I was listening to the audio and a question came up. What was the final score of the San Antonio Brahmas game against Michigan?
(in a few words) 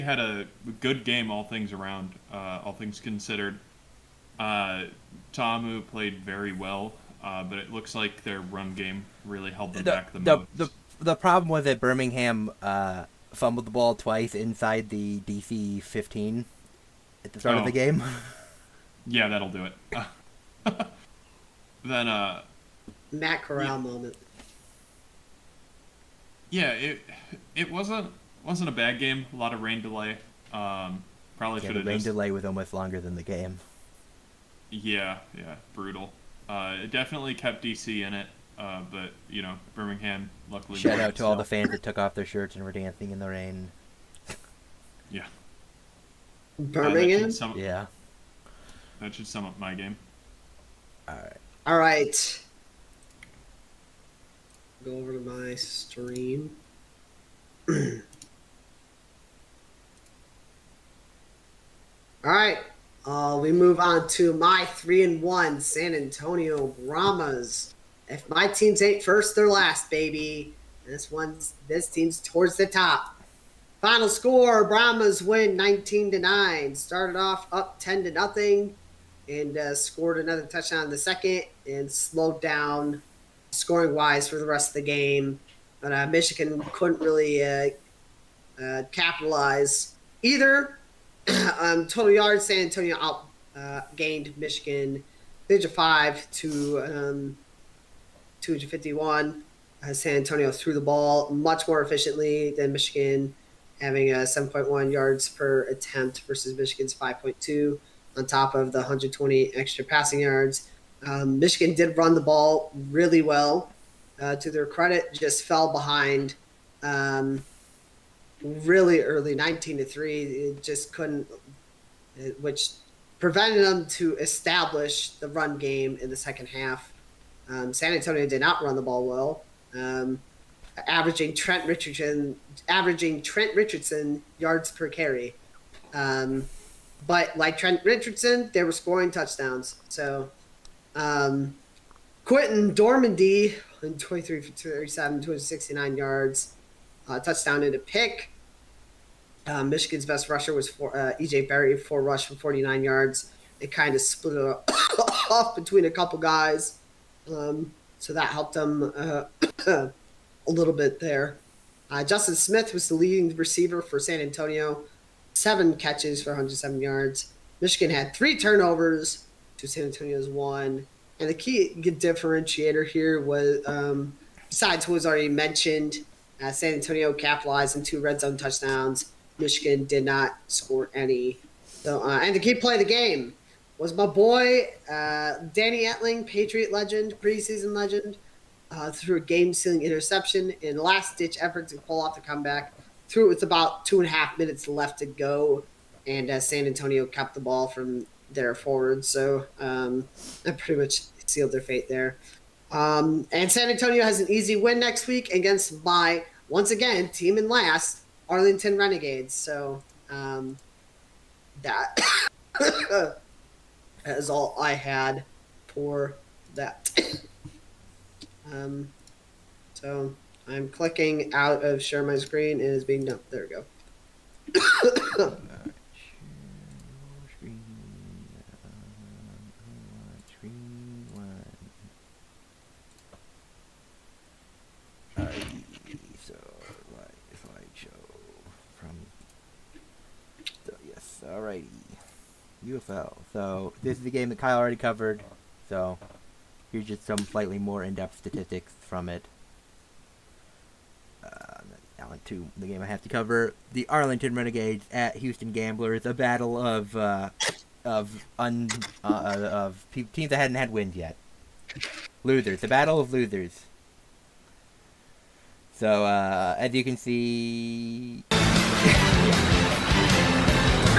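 19 to 9.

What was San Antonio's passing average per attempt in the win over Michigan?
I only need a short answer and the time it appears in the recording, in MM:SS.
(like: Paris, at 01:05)
7.1 yards, at 01:44.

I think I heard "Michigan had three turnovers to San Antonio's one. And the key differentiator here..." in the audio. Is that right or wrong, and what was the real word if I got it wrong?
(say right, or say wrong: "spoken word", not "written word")
right.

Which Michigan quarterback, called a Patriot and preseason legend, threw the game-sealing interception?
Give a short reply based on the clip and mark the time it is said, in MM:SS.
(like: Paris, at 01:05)
Danny Etling, at 03:05.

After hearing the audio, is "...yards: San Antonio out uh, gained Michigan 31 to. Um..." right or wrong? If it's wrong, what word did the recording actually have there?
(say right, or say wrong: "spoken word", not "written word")
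wrong: "35", not "31".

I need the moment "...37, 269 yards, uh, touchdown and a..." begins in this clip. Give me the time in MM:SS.
02:24.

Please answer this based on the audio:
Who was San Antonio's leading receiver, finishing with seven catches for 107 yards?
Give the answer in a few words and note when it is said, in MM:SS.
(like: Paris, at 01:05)
Justin Smith, at 02:42.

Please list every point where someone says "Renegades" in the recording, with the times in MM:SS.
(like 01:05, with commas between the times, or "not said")
03:28, 04:14.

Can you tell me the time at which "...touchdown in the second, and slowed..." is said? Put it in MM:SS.
01:20.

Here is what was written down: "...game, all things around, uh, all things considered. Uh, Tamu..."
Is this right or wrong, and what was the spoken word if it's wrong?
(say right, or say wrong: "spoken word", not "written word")
right.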